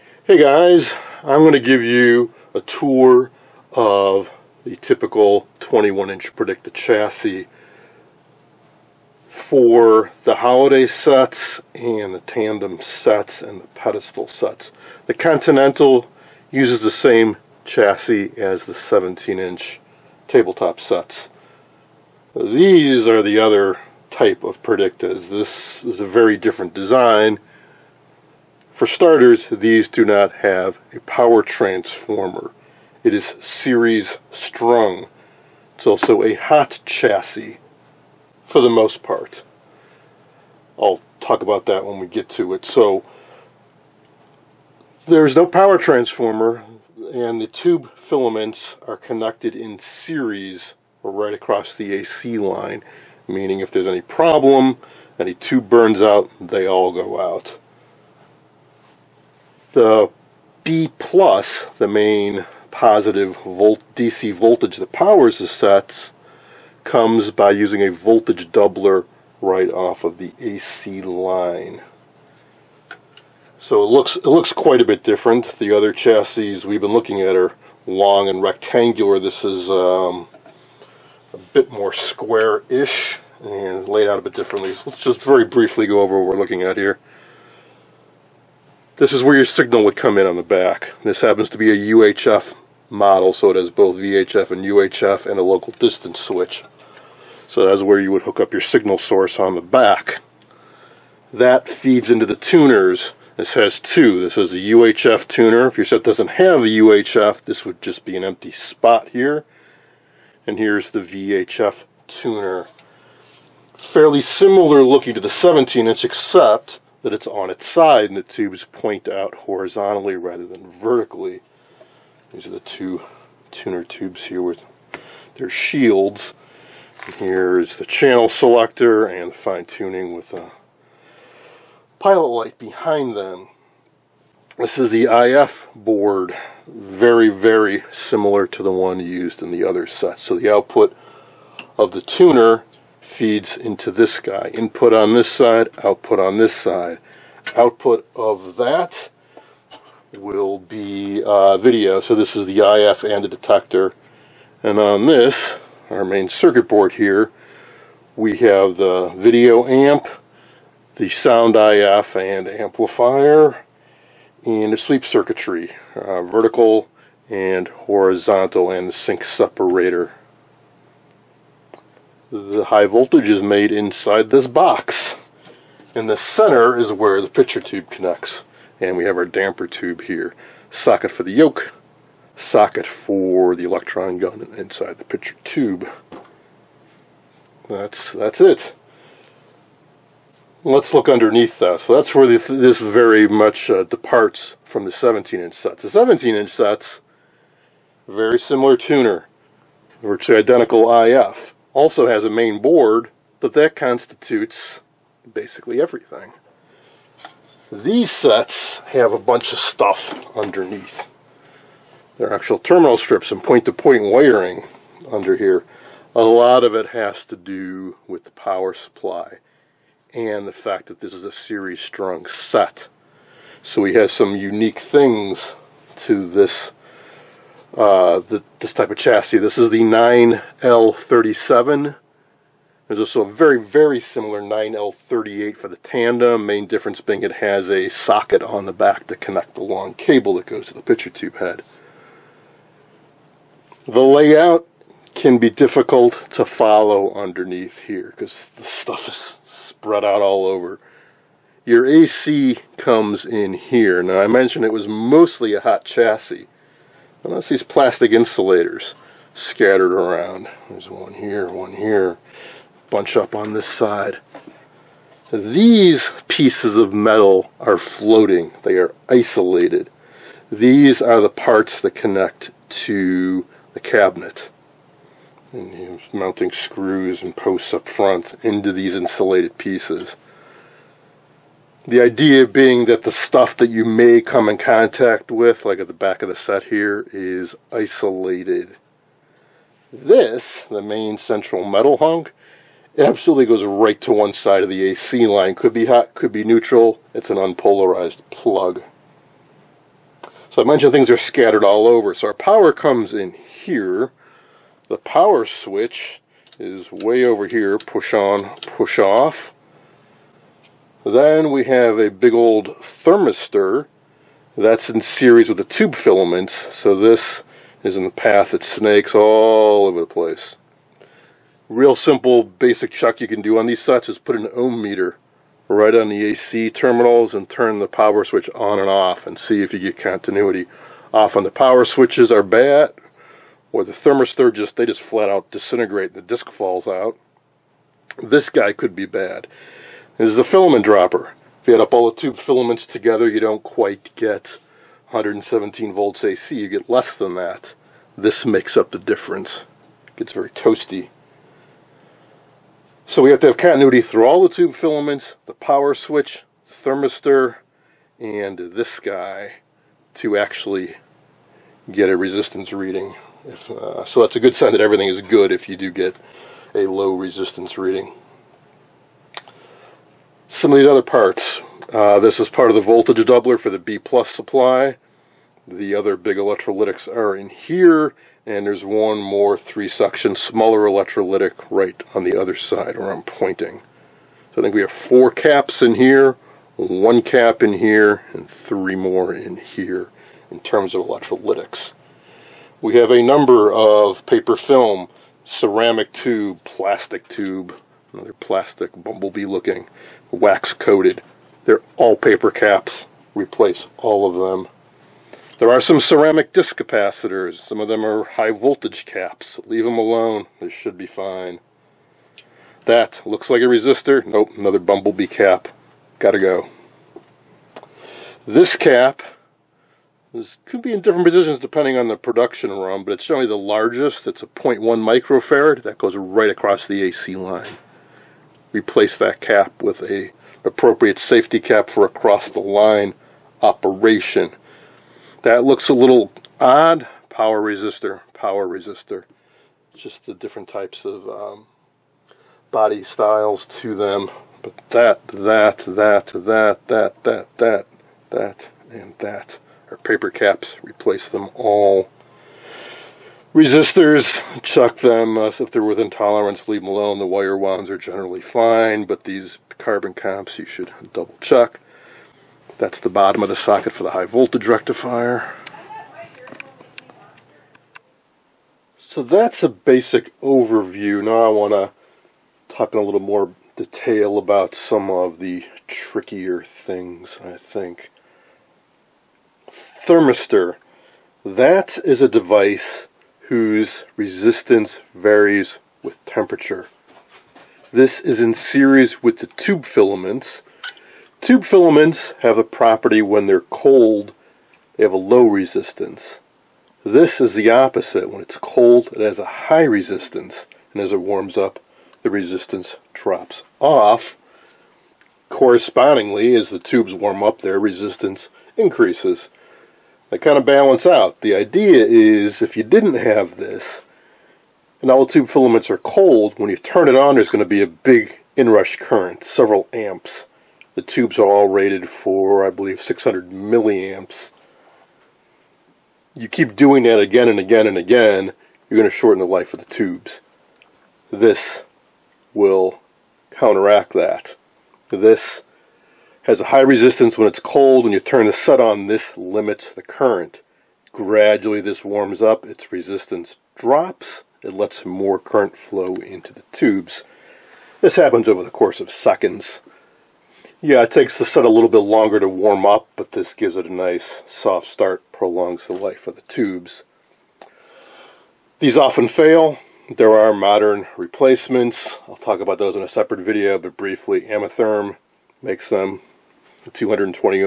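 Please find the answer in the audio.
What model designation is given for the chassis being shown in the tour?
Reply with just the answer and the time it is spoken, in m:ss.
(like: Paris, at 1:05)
9L37, at 3:49.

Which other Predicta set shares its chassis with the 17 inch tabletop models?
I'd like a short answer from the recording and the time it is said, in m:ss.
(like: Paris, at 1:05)
The Continental, at 0:15.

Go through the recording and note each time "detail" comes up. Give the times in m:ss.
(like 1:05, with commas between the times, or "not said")
7:53.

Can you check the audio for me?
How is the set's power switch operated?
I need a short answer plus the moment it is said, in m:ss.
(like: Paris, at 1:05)
push on, push off, at 5:07.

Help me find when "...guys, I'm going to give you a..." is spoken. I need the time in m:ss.
0:00.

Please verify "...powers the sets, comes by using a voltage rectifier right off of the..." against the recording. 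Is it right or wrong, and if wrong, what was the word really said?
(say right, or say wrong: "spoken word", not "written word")
wrong: "doubler", not "rectifier".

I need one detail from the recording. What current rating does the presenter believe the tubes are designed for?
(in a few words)
600 milliamps.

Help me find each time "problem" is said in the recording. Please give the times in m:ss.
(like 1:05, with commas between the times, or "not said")
0:54.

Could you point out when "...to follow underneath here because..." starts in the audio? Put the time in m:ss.
4:06.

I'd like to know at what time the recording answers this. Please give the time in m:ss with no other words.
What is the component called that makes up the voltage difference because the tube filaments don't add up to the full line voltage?
5:40.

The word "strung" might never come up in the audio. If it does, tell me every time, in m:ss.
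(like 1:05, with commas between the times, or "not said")
0:34, 3:41.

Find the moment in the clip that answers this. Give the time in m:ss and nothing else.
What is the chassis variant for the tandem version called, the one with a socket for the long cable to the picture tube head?
3:54.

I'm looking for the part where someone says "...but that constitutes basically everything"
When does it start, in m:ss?
3:23.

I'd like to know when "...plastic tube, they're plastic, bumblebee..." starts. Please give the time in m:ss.
6:36.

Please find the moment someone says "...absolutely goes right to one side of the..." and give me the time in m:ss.
4:52.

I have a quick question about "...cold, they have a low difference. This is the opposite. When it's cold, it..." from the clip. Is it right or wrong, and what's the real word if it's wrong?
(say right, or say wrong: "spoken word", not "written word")
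wrong: "resistance", not "difference".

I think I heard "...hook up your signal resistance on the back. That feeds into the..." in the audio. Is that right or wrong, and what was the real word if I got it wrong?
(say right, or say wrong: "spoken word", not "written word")
wrong: "source", not "resistance".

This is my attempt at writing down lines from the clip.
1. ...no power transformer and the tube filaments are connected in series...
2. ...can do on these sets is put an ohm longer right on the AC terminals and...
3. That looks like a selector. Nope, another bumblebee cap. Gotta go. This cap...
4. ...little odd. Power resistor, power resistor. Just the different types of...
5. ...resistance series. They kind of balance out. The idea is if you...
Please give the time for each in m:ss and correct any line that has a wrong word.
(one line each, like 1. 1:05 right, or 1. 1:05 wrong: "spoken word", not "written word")
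1. 0:45 right
2. 5:23 wrong: "meter", not "longer"
3. 6:52 wrong: "resistor", not "selector"
4. 7:15 right
5. 8:27 wrong: "increases", not "series".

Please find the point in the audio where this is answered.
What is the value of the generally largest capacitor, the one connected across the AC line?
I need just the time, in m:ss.
7:04.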